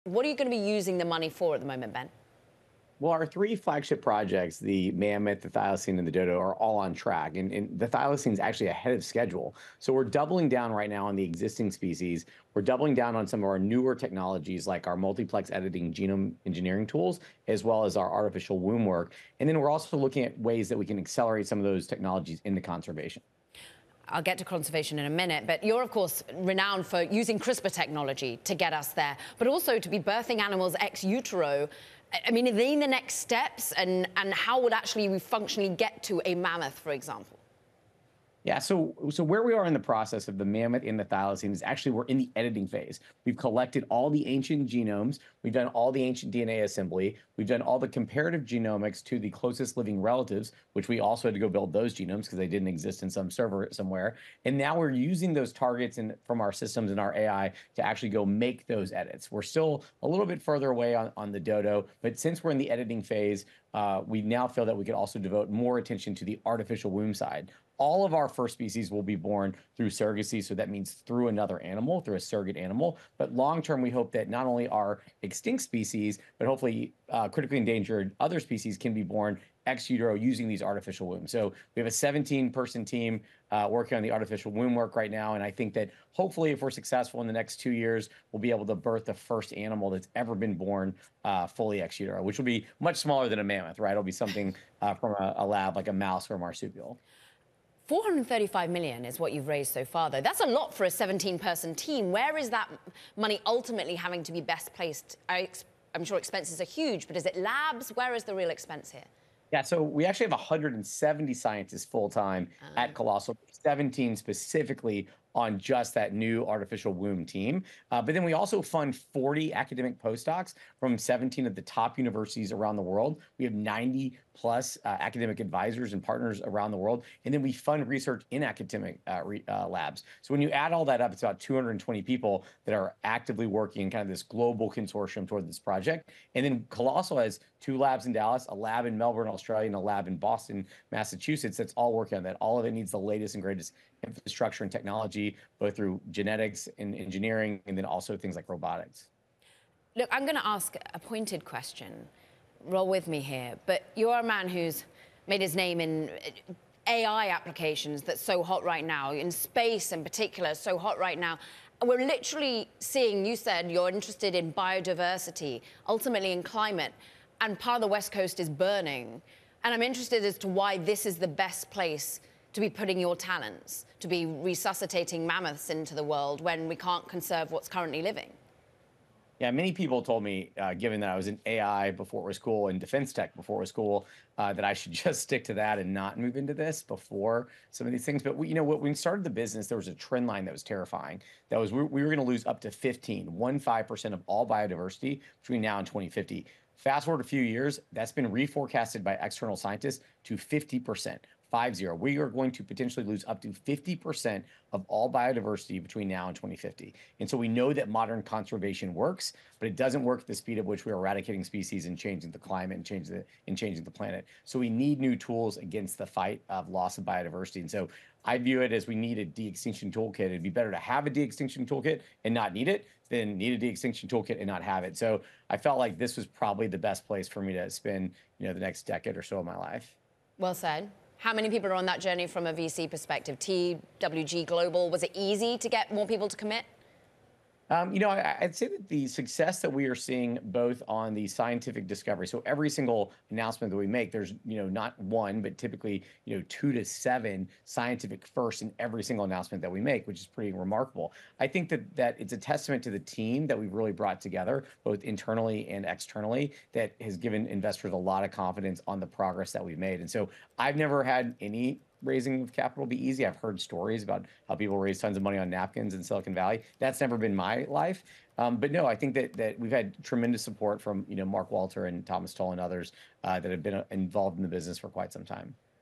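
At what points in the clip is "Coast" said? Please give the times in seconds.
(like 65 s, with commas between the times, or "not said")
168 s.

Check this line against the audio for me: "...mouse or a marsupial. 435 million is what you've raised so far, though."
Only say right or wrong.
right.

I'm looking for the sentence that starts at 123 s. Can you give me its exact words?
We have 90 plus uh, academic advisors and partners around the world.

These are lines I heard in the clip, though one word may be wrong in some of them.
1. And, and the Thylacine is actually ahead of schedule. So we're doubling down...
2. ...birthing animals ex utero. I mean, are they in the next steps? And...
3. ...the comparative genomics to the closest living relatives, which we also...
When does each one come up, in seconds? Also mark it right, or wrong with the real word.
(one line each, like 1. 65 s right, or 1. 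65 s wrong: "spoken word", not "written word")
1. 7 s right
2. 29 s right
3. 47 s right.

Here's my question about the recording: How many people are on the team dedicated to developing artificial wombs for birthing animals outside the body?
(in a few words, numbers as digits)
17.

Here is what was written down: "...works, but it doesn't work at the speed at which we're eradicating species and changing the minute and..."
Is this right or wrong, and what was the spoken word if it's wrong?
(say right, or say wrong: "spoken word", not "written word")
wrong: "climate", not "minute".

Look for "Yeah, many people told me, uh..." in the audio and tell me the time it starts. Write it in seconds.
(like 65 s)
179 s.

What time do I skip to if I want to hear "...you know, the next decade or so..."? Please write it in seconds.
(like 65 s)
228 s.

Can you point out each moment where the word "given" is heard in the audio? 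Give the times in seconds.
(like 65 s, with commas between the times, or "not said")
180 s, 257 s.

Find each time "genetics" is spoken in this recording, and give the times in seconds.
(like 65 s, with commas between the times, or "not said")
146 s.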